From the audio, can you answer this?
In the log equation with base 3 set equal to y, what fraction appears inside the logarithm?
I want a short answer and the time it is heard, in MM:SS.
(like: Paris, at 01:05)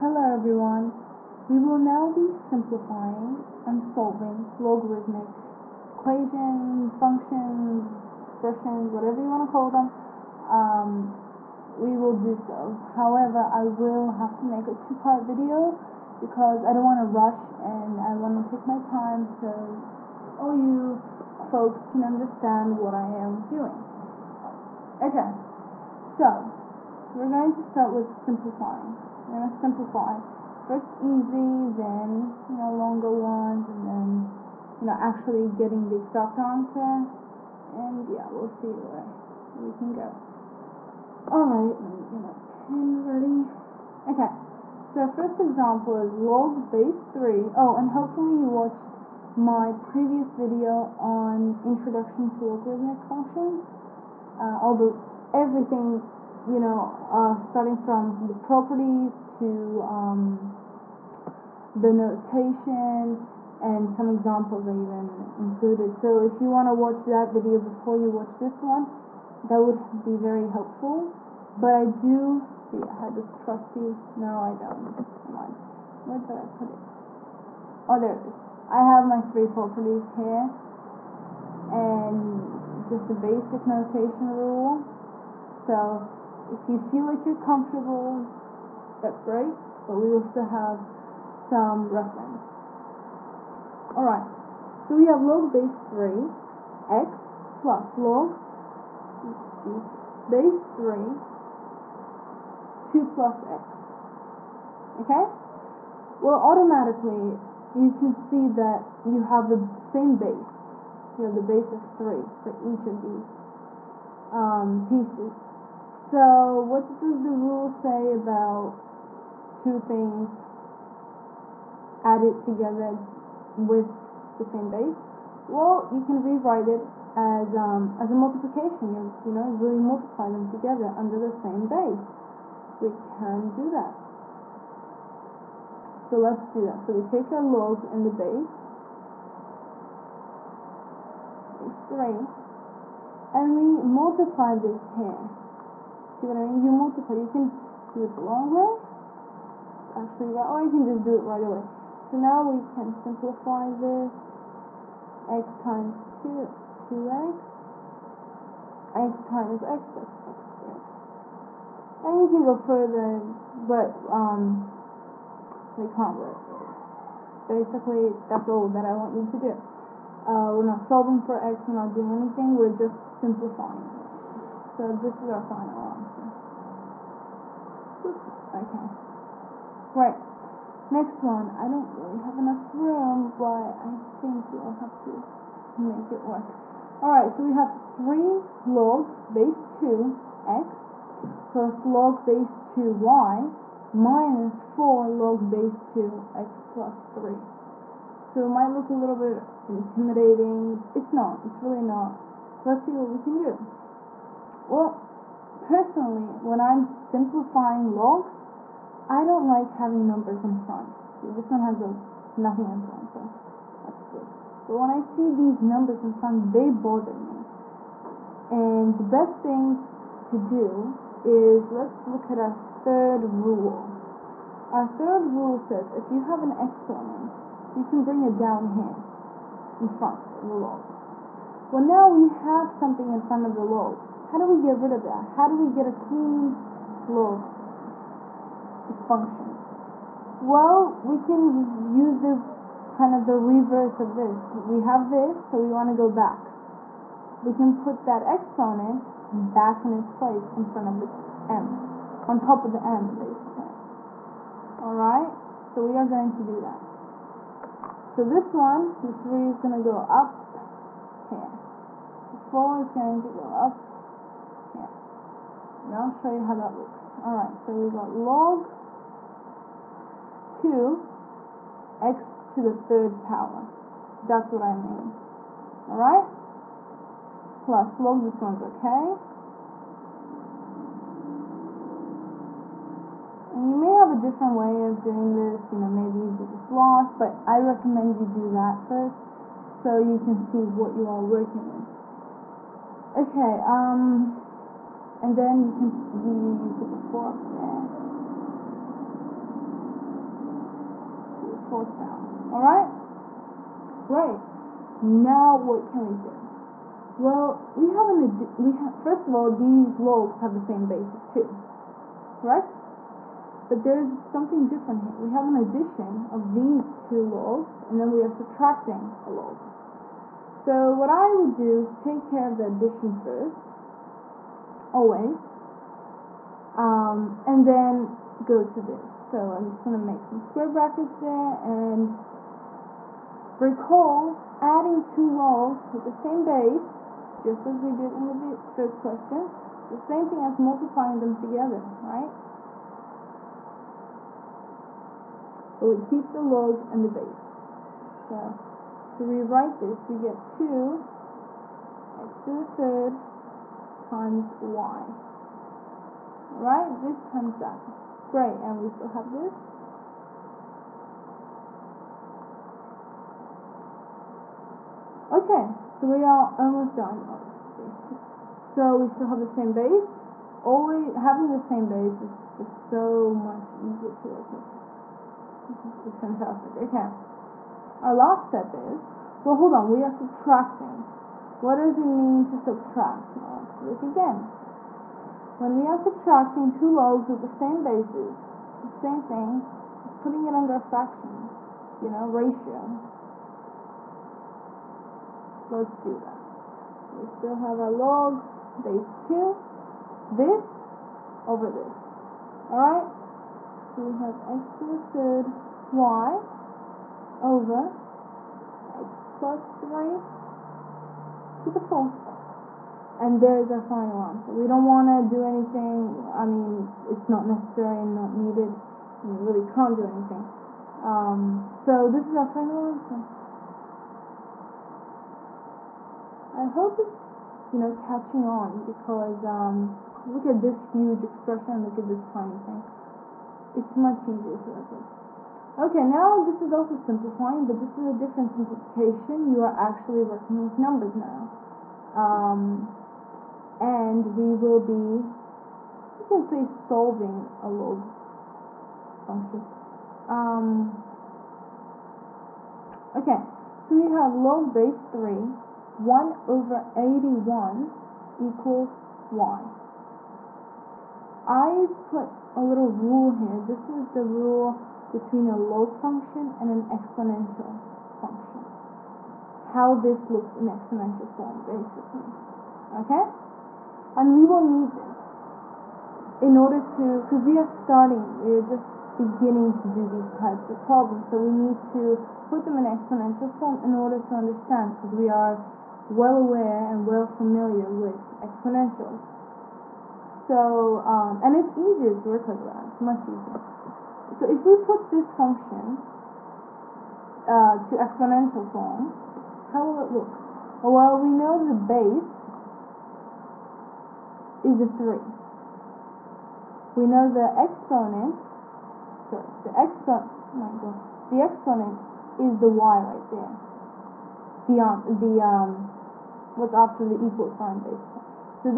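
1/81, at 07:35.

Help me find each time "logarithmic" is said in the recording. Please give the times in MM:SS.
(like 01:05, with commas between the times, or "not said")
00:04, 00:52.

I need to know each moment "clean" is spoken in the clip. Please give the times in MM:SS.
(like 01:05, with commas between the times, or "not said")
03:55.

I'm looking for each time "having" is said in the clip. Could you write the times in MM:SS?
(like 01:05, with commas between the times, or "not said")
03:29, 06:11.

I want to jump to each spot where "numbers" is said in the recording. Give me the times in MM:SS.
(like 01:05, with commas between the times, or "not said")
03:30, 03:35, 07:20.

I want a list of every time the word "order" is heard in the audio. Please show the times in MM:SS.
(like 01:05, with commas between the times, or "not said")
07:56, 08:03.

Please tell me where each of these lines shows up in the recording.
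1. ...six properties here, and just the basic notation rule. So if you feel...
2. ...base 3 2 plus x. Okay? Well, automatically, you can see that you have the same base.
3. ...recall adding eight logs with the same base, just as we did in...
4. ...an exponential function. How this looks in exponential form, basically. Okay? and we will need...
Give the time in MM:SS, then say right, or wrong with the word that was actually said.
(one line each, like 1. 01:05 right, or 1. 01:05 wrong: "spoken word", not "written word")
1. 01:19 wrong: "three", not "six"
2. 01:40 right
3. 05:33 wrong: "two", not "eight"
4. 07:46 right.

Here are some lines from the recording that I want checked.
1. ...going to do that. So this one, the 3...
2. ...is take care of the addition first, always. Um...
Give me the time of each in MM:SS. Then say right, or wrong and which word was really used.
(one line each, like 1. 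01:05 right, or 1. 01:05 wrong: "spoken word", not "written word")
1. 04:16 right
2. 05:21 right.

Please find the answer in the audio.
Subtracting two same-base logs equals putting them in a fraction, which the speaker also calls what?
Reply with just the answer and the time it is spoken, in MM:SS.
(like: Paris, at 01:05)
ratio, at 06:32.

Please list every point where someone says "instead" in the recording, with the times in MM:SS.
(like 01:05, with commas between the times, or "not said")
not said.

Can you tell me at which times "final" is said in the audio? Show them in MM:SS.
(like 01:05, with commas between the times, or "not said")
02:55, 06:53, 07:02.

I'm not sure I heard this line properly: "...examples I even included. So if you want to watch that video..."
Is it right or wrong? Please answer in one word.
right.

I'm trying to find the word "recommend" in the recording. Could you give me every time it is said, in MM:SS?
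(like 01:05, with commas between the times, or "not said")
04:47.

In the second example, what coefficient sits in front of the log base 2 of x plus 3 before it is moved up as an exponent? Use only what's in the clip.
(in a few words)
4.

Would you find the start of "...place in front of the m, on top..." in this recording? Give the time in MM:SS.
04:10.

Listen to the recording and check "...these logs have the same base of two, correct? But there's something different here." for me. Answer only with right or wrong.
right.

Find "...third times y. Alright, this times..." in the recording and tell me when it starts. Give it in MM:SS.
05:52.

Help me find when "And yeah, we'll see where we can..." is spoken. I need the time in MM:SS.
00:37.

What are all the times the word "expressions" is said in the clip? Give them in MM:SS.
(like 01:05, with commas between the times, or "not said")
00:08, 07:11.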